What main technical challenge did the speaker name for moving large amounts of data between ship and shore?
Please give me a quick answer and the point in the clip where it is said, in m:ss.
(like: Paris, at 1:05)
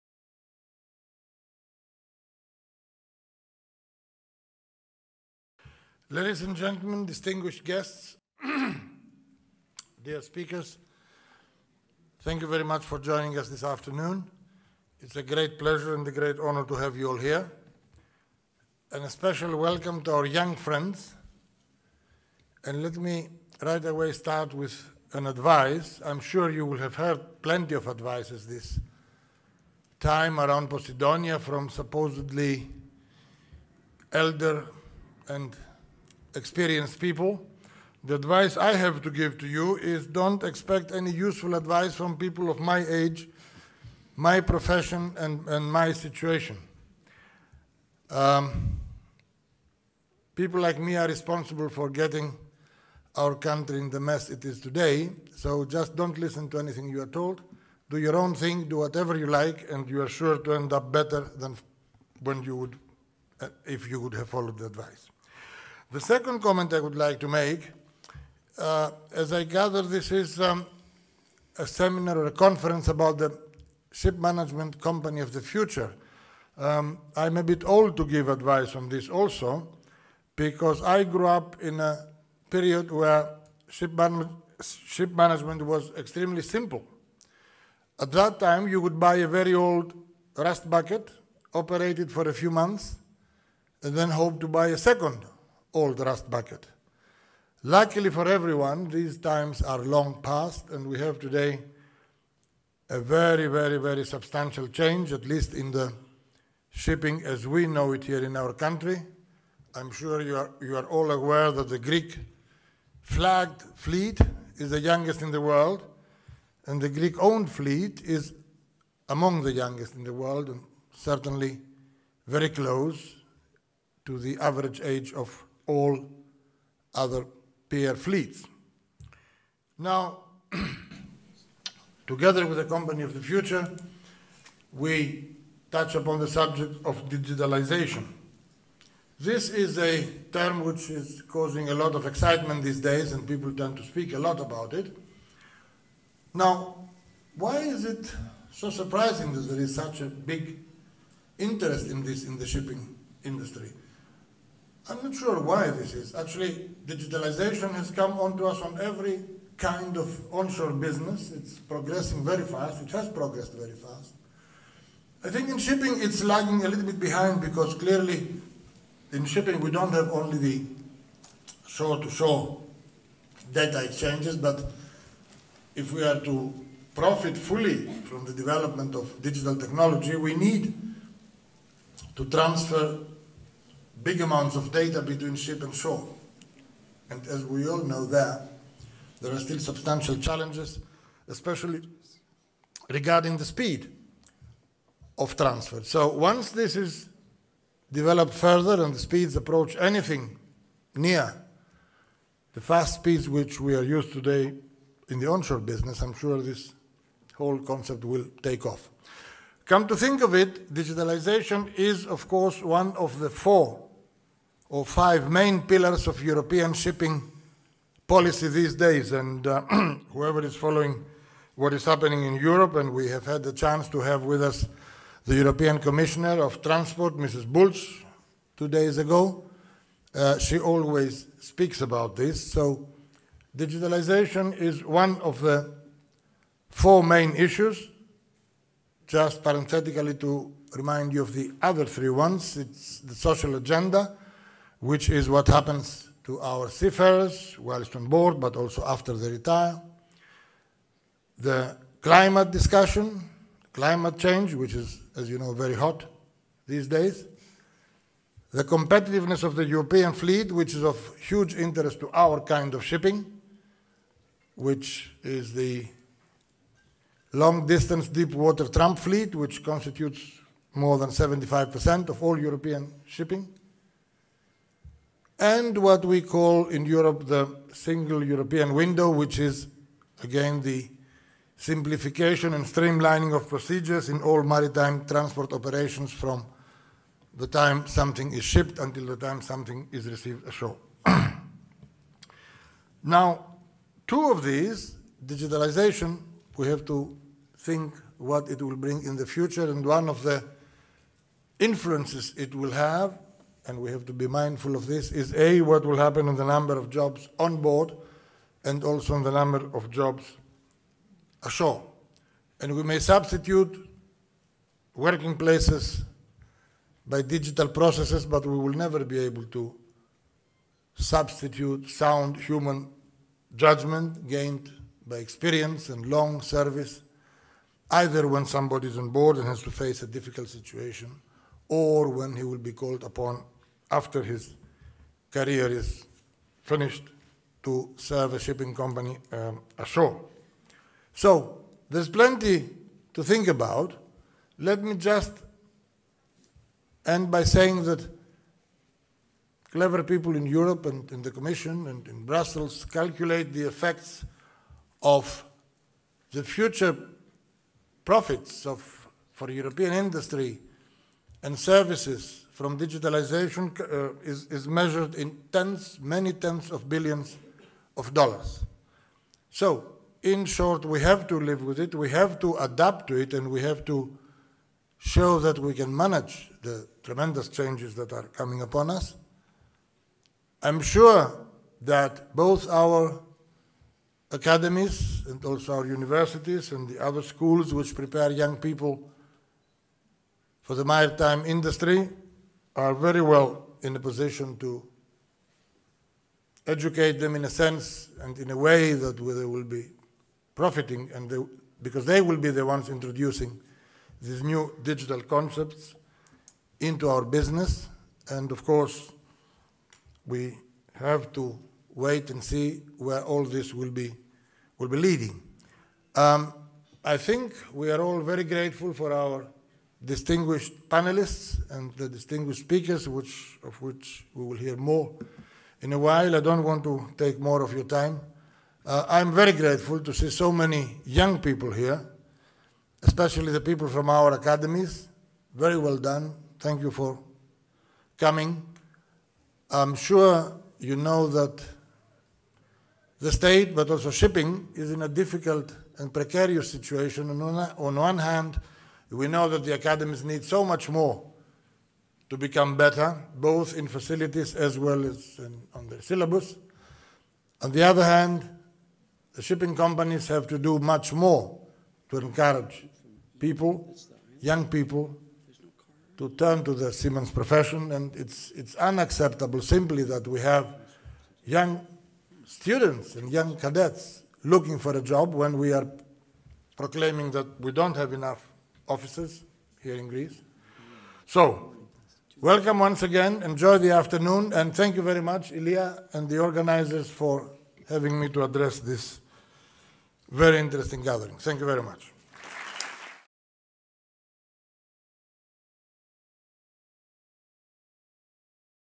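speed of transfer, at 3:13.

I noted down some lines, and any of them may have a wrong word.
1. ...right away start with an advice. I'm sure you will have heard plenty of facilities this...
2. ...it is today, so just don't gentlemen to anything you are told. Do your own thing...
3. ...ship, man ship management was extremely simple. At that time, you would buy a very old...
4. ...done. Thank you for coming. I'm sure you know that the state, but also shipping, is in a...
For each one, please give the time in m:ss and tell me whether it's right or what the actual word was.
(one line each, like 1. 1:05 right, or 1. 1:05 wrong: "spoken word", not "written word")
1. 0:23 wrong: "advices", not "facilities"
2. 0:54 wrong: "listen", not "gentlemen"
3. 1:23 right
4. 7:15 right.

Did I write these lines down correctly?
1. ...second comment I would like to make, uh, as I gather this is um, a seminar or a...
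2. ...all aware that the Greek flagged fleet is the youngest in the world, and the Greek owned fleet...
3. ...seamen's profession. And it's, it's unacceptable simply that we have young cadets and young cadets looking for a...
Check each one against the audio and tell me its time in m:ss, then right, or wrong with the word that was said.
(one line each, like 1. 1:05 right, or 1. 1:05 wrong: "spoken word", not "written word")
1. 1:05 right
2. 1:50 right
3. 7:46 wrong: "students", not "cadets".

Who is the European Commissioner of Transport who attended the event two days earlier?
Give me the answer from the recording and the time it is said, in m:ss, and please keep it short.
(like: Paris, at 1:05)
Mrs. Bulch, at 3:47.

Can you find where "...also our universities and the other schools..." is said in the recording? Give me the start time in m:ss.
6:25.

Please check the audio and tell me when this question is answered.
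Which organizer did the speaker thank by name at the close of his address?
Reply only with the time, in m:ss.
8:05.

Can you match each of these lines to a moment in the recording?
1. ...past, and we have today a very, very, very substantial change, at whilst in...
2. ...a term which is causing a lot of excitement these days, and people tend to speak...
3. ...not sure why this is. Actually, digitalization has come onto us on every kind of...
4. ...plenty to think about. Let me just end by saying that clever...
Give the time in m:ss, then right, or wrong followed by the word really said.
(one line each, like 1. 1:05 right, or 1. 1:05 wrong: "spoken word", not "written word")
1. 1:40 wrong: "least", not "whilst"
2. 2:19 right
3. 2:35 right
4. 5:42 right.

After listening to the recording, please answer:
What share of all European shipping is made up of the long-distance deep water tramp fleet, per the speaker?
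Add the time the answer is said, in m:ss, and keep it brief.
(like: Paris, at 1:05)
more than 75%, at 4:30.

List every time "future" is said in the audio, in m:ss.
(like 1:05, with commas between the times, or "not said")
1:15, 2:13, 4:59, 5:56.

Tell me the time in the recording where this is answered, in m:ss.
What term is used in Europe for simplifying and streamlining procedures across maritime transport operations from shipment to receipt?
4:37.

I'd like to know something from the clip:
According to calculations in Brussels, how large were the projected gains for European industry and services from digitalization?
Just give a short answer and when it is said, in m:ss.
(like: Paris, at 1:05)
many tens of billions of dollars, at 6:05.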